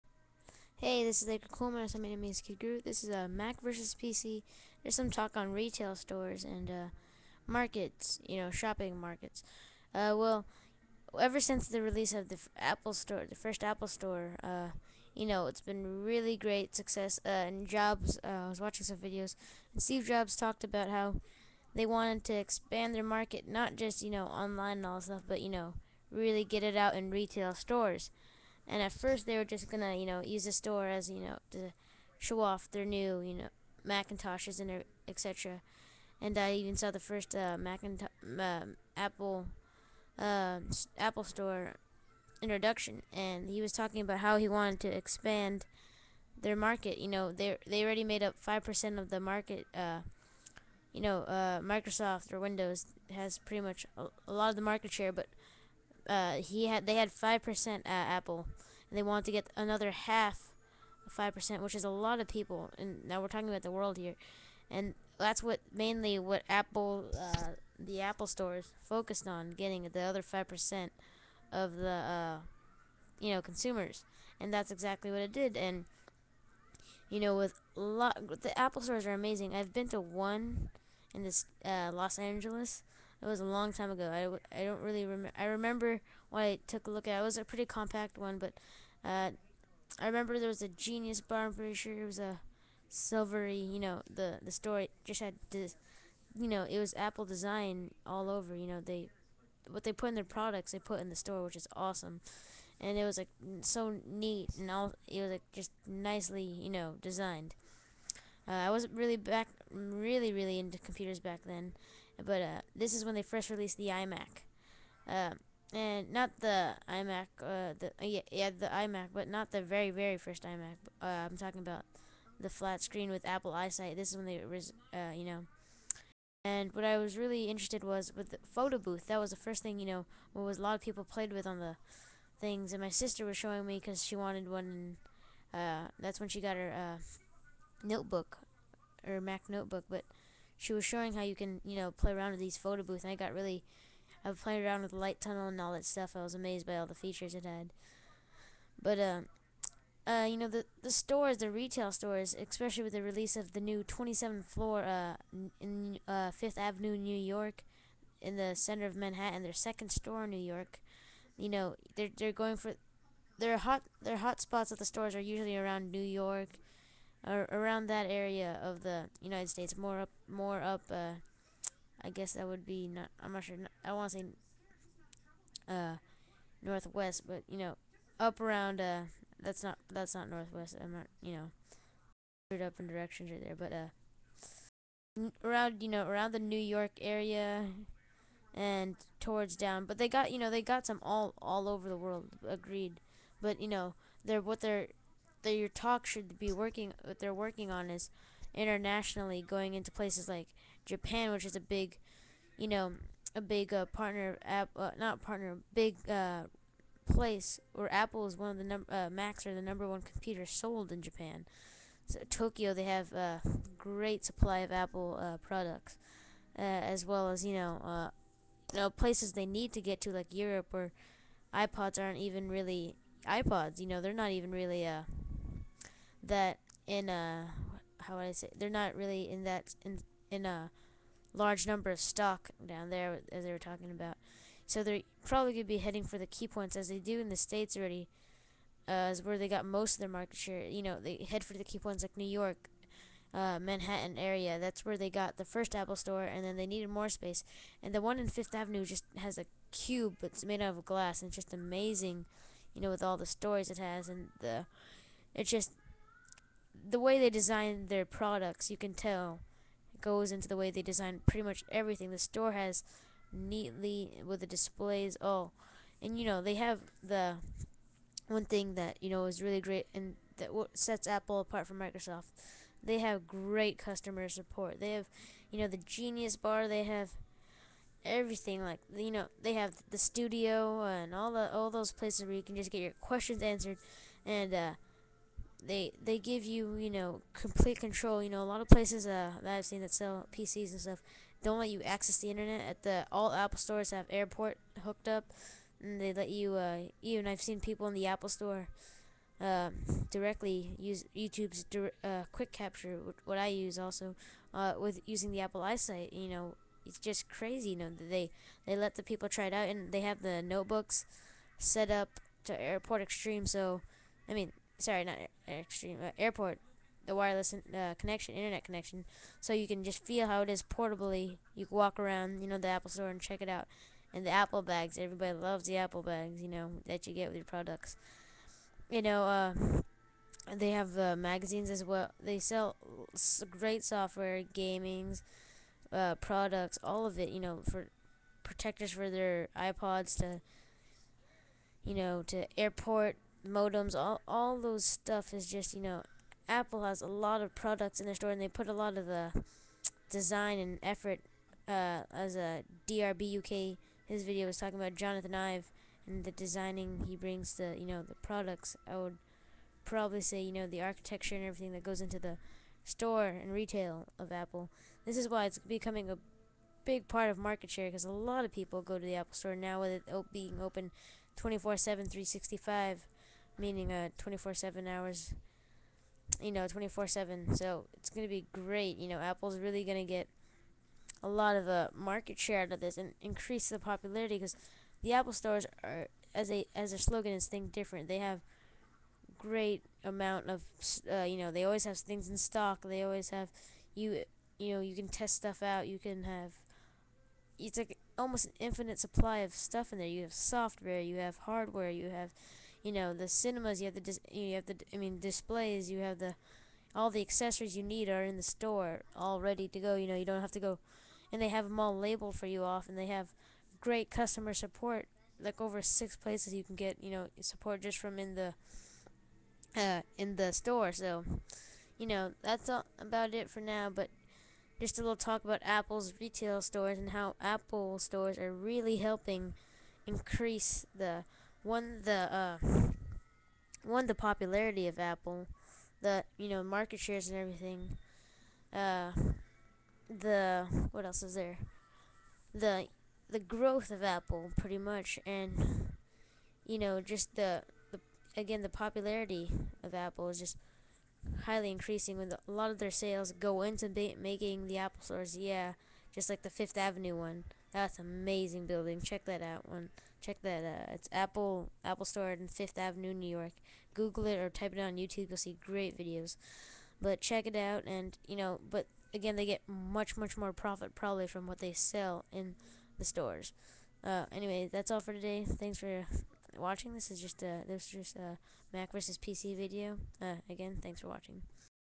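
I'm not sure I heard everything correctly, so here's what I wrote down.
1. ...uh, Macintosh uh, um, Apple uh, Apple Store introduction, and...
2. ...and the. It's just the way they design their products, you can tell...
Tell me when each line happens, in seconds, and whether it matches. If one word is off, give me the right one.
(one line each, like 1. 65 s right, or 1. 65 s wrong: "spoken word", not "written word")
1. 37 s right
2. 254 s right.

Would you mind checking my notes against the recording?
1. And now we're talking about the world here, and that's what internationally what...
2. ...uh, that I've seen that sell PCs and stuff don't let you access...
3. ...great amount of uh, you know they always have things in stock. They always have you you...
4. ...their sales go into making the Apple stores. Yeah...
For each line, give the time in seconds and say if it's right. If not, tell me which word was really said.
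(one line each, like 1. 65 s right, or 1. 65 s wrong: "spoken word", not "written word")
1. 62 s wrong: "mainly", not "internationally"
2. 289 s right
3. 389 s right
4. 452 s right.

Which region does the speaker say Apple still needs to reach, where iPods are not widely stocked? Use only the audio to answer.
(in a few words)
Europe.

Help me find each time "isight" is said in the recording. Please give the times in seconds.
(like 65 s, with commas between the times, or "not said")
123 s, 305 s.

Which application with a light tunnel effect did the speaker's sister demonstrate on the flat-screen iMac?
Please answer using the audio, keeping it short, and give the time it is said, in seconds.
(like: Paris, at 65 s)
Photo Booth, at 128 s.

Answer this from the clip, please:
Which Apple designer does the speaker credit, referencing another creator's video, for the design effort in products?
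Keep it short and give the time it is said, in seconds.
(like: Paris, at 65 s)
Jonathan Ive, at 354 s.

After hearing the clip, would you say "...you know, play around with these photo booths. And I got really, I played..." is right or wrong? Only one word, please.
right.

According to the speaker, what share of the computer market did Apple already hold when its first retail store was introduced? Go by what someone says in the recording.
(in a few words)
5 percent.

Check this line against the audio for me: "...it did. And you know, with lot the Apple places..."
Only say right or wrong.
wrong.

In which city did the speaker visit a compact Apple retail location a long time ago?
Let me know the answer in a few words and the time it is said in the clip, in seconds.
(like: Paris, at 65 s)
Los Angeles, at 81 s.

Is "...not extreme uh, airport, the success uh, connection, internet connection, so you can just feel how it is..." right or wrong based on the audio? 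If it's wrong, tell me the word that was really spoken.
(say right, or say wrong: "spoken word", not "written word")
wrong: "wireless", not "success".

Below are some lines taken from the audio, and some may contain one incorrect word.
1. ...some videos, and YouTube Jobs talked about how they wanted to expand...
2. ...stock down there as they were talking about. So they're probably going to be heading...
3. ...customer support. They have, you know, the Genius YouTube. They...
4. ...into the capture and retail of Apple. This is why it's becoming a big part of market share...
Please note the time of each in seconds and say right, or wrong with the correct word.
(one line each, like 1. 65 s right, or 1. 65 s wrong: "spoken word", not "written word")
1. 18 s wrong: "Steve", not "YouTube"
2. 231 s right
3. 273 s wrong: "Bar", not "YouTube"
4. 362 s wrong: "store", not "capture".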